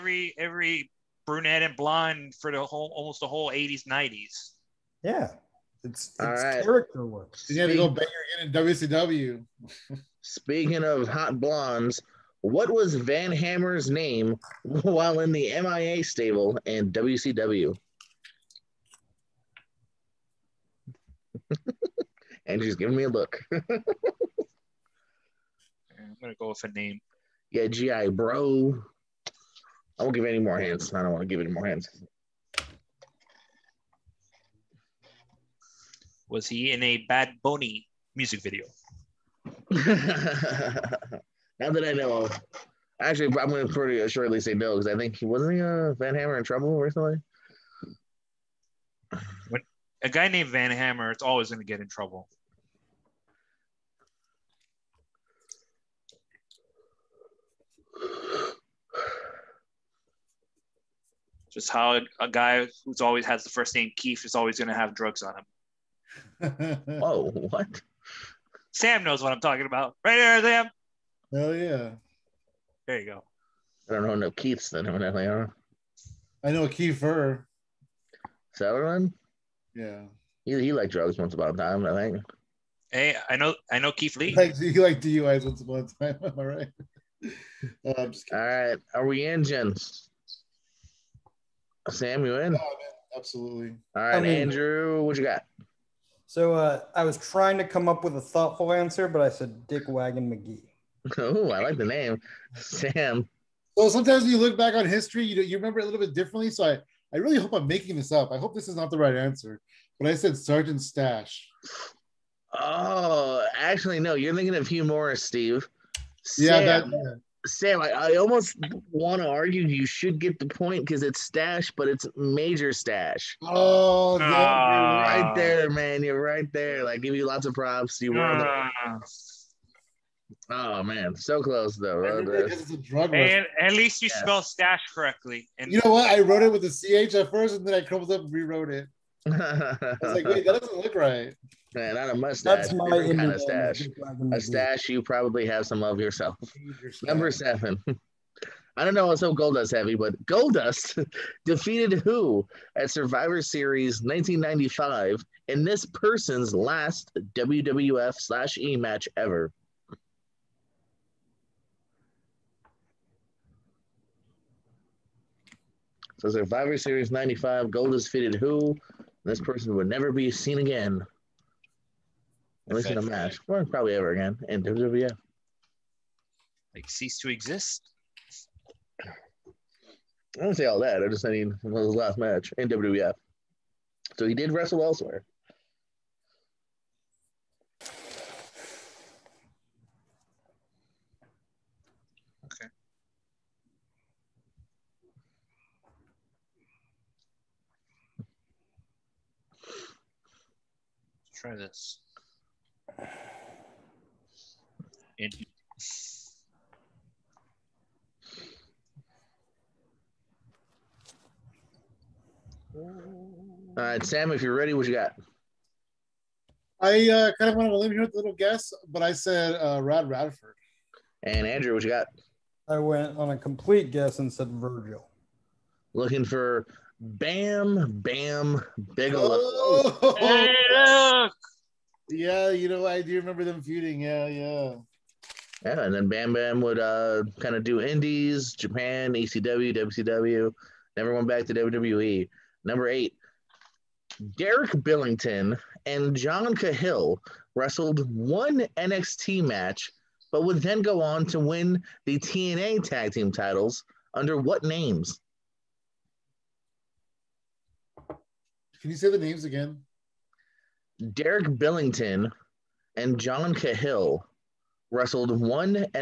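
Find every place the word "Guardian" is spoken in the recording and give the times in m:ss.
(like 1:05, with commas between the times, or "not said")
not said.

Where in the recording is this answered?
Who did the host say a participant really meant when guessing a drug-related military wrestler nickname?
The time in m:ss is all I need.
1:54.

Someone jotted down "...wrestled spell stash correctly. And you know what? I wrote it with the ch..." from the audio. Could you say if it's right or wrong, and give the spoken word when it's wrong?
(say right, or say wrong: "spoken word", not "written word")
wrong: "spelled", not "wrestled".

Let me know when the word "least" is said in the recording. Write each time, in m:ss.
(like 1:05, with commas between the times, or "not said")
2:13, 2:52.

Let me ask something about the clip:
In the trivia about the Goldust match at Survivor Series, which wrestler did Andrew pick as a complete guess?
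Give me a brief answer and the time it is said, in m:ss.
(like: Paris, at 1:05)
Virgil, at 3:44.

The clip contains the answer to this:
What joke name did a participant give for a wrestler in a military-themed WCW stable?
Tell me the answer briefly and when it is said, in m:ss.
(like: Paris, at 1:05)
Dick Wagon McGee, at 1:39.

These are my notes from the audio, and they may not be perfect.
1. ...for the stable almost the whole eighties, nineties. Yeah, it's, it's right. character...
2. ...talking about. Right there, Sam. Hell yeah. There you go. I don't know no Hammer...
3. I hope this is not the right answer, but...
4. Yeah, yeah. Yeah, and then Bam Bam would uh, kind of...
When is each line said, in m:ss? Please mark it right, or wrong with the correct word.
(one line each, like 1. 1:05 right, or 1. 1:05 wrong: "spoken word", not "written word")
1. 0:02 wrong: "whole", not "stable"
2. 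1:09 wrong: "Keiths", not "Hammer"
3. 1:48 right
4. 3:54 right.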